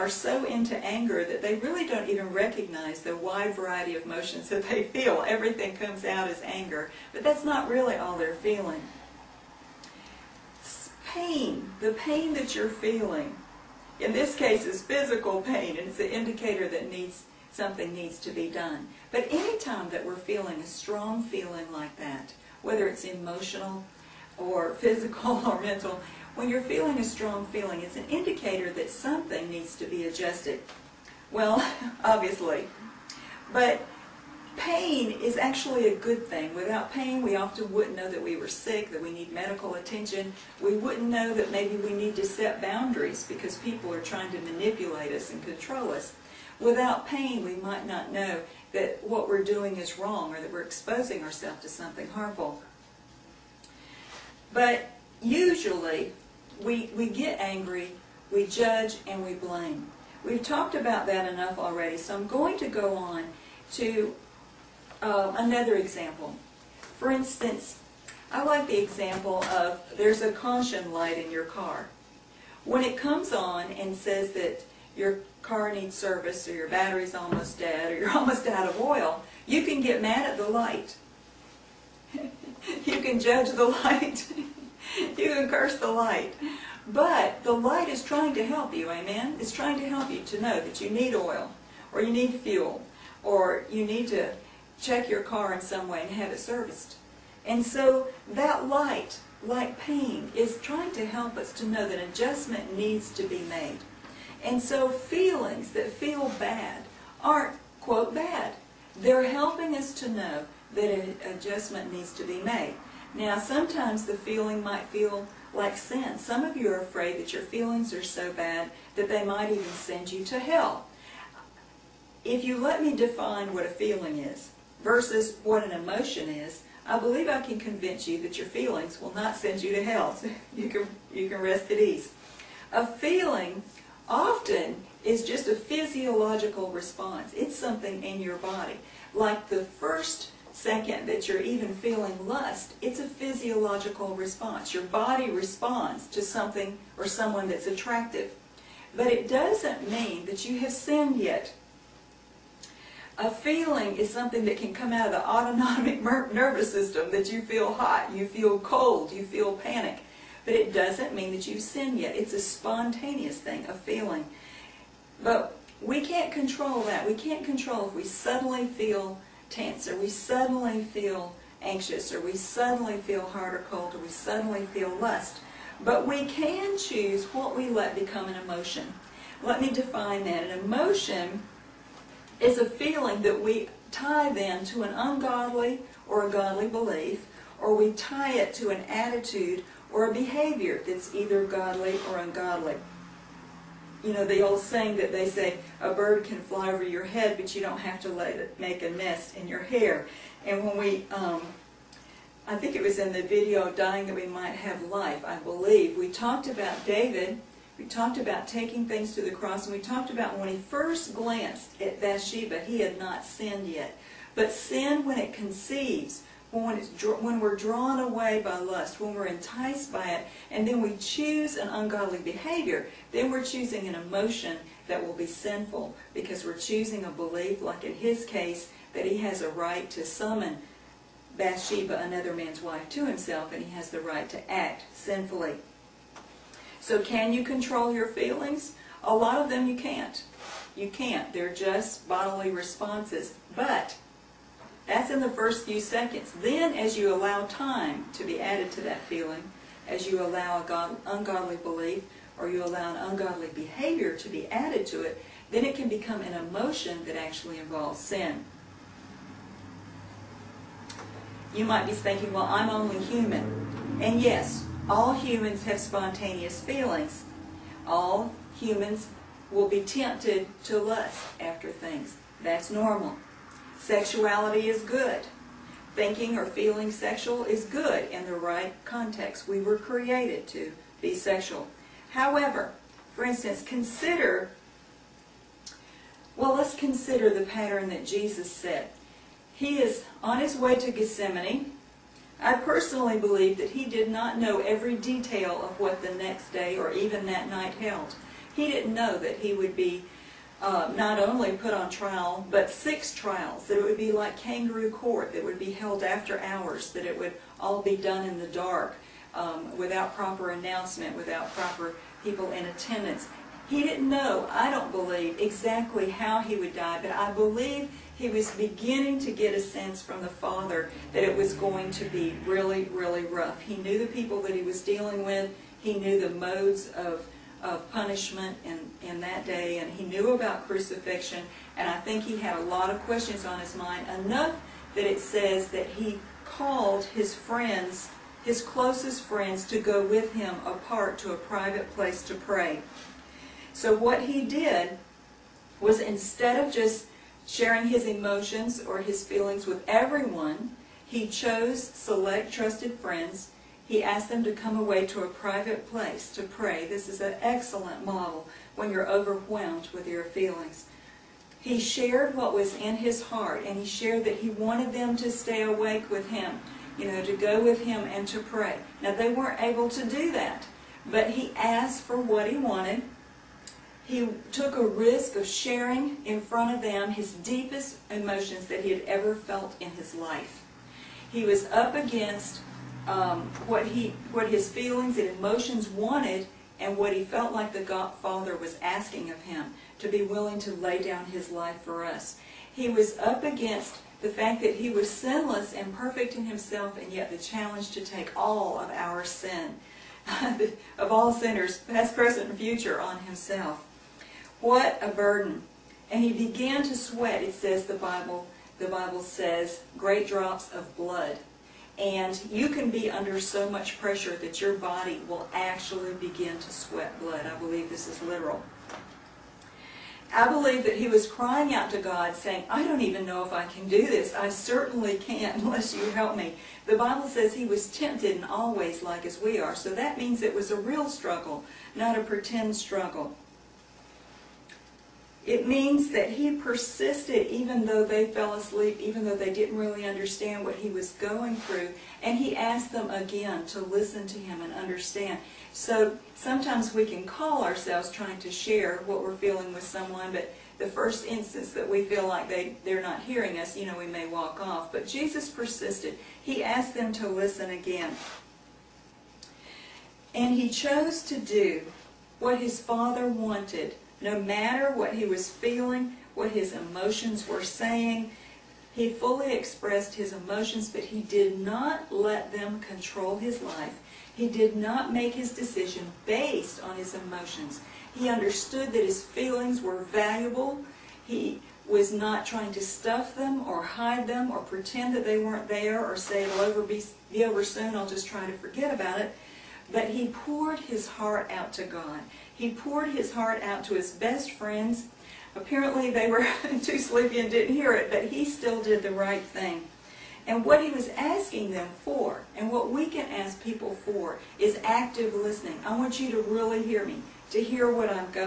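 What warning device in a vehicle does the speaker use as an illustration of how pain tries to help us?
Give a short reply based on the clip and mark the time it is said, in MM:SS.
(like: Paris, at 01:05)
Caution light, at 01:10.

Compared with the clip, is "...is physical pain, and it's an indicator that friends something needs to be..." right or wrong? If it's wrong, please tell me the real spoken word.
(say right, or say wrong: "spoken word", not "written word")
wrong: "needs", not "friends".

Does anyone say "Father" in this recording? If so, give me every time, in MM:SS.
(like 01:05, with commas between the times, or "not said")
05:20, 06:28, 07:42.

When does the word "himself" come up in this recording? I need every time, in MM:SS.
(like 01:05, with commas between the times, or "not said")
03:53, 06:36, 06:43.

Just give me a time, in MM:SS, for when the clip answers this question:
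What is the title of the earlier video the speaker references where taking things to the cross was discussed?
03:23.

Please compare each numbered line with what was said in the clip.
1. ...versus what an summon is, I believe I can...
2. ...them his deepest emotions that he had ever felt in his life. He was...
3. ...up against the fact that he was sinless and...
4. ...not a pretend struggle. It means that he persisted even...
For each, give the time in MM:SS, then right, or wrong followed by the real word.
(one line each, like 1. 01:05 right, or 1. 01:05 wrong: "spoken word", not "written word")
1. 02:04 wrong: "emotion", not "summon"
2. 06:16 right
3. 06:33 right
4. 07:11 right.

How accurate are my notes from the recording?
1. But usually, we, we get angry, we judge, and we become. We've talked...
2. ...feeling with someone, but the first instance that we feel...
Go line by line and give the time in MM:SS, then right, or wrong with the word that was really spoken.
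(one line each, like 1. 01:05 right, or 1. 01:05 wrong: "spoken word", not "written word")
1. 00:54 wrong: "blame", not "become"
2. 07:29 right.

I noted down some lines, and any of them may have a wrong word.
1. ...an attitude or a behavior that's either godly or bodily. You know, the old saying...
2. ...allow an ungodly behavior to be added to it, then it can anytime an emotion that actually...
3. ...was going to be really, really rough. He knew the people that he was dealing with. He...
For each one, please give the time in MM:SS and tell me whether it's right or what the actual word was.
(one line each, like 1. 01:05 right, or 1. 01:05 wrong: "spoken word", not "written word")
1. 03:08 wrong: "ungodly", not "bodily"
2. 04:12 wrong: "become", not "anytime"
3. 05:21 right.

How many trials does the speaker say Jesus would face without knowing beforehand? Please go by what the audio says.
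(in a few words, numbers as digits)
6.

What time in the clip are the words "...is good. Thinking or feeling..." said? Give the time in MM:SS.
04:34.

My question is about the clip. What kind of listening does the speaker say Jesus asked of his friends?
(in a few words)
Active listening.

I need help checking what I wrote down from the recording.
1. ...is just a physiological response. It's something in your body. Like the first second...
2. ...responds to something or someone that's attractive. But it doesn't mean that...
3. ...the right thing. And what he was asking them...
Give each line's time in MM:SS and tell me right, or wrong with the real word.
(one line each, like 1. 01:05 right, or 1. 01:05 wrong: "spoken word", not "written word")
1. 02:15 right
2. 02:25 right
3. 08:19 right.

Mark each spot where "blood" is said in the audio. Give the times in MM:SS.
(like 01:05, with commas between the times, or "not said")
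06:50, 06:57.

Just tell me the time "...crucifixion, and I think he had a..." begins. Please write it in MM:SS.
05:30.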